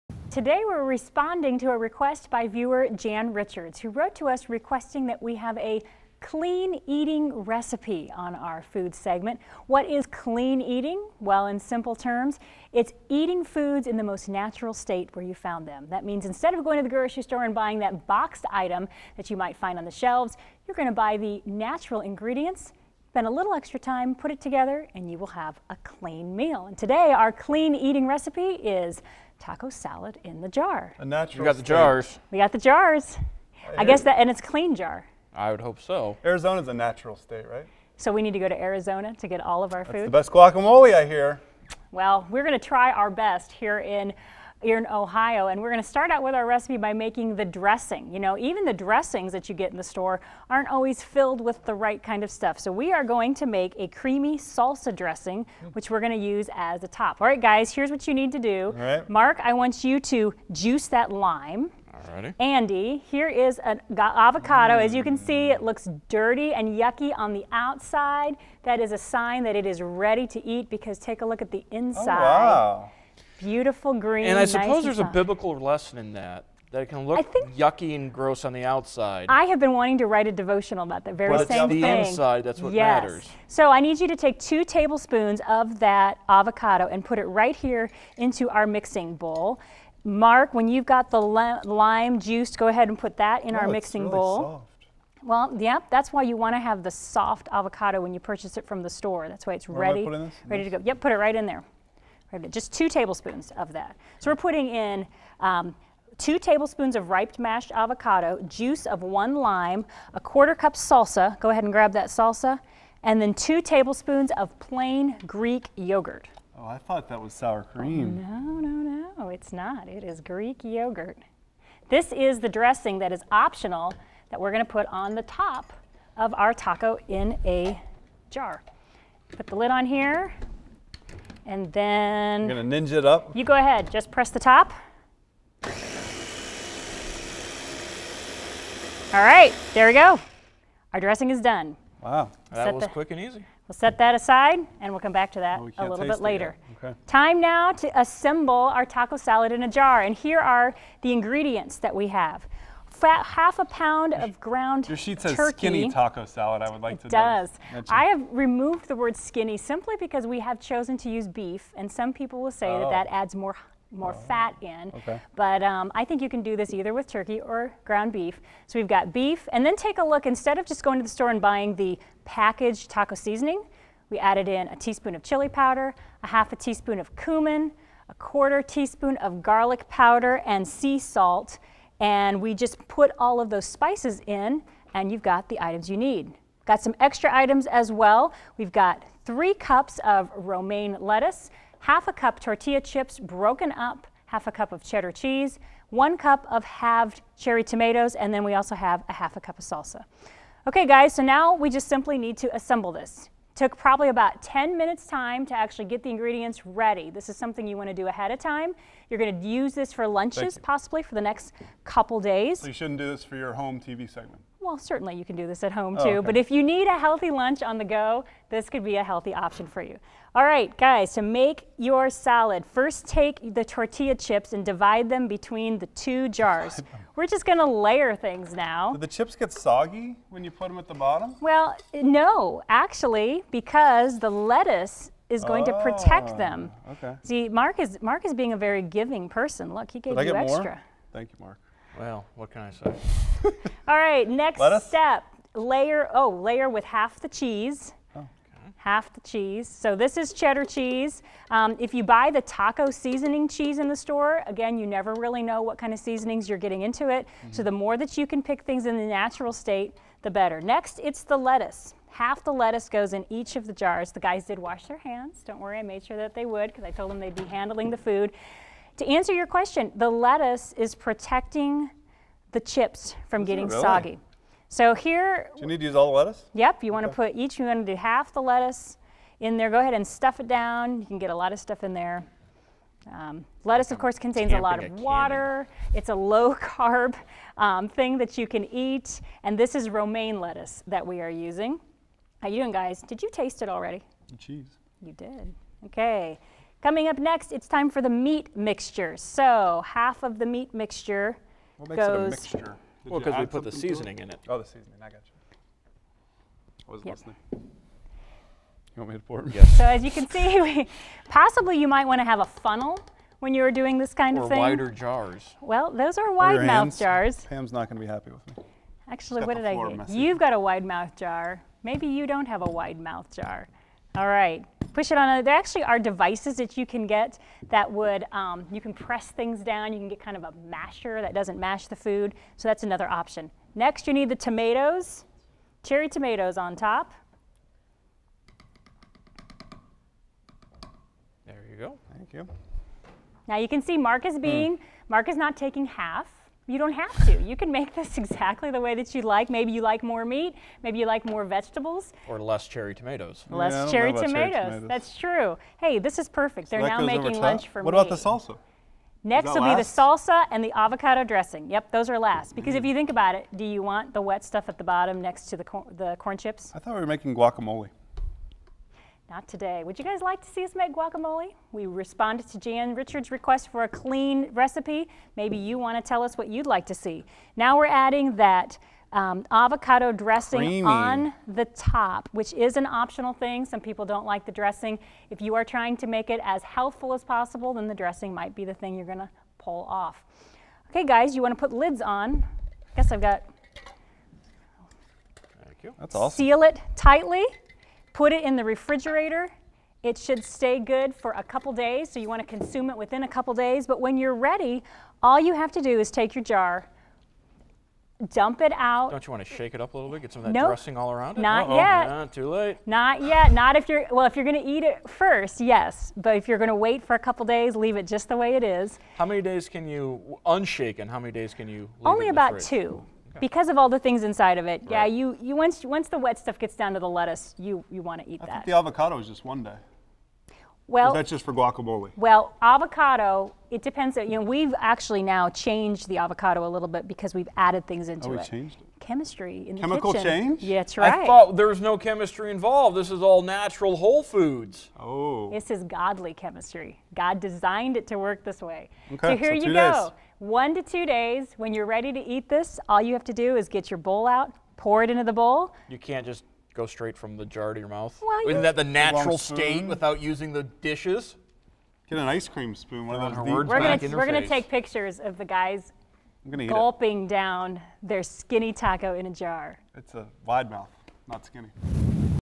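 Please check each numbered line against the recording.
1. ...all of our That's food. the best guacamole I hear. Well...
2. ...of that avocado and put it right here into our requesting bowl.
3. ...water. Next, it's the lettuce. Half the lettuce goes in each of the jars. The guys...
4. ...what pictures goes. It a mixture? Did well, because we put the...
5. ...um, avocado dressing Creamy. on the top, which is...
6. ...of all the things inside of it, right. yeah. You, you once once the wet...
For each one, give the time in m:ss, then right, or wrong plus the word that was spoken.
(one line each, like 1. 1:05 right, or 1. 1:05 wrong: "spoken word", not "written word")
1. 0:39 right
2. 1:25 wrong: "mixing", not "requesting"
3. 4:20 wrong: "better", not "water"
4. 5:01 wrong: "makes", not "pictures"
5. 6:19 right
6. 7:03 right.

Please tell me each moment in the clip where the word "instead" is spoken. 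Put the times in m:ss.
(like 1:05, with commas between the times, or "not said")
0:16, 2:50.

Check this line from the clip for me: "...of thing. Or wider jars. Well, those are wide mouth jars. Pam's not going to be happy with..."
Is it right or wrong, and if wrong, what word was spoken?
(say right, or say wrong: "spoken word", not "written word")
right.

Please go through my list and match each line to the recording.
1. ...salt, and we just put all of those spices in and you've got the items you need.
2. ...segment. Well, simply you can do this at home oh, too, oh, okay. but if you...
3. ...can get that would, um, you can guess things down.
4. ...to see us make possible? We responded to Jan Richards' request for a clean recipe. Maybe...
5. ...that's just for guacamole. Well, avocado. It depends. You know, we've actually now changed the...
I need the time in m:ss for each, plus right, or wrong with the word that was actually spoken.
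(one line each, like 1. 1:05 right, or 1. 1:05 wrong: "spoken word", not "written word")
1. 3:00 right
2. 3:34 wrong: "certainly", not "simply"
3. 5:26 wrong: "press", not "guess"
4. 6:10 wrong: "guacamole", not "possible"
5. 7:11 right.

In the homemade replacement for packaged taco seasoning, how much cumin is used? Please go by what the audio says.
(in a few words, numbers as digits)
1/2 teaspoon.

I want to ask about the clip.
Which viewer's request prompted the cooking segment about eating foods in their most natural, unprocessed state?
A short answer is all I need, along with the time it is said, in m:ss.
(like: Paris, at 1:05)
Jan Richards, at 0:02.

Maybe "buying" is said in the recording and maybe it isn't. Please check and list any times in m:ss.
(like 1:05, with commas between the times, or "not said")
0:17, 2:51.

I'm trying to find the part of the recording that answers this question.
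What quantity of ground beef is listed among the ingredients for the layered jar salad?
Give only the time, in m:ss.
2:33.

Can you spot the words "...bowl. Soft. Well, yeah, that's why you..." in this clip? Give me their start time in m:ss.
1:34.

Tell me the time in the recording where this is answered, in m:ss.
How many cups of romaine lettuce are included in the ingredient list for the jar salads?
3:09.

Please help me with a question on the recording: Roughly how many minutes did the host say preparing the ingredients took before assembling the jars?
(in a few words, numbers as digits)
10 minutes.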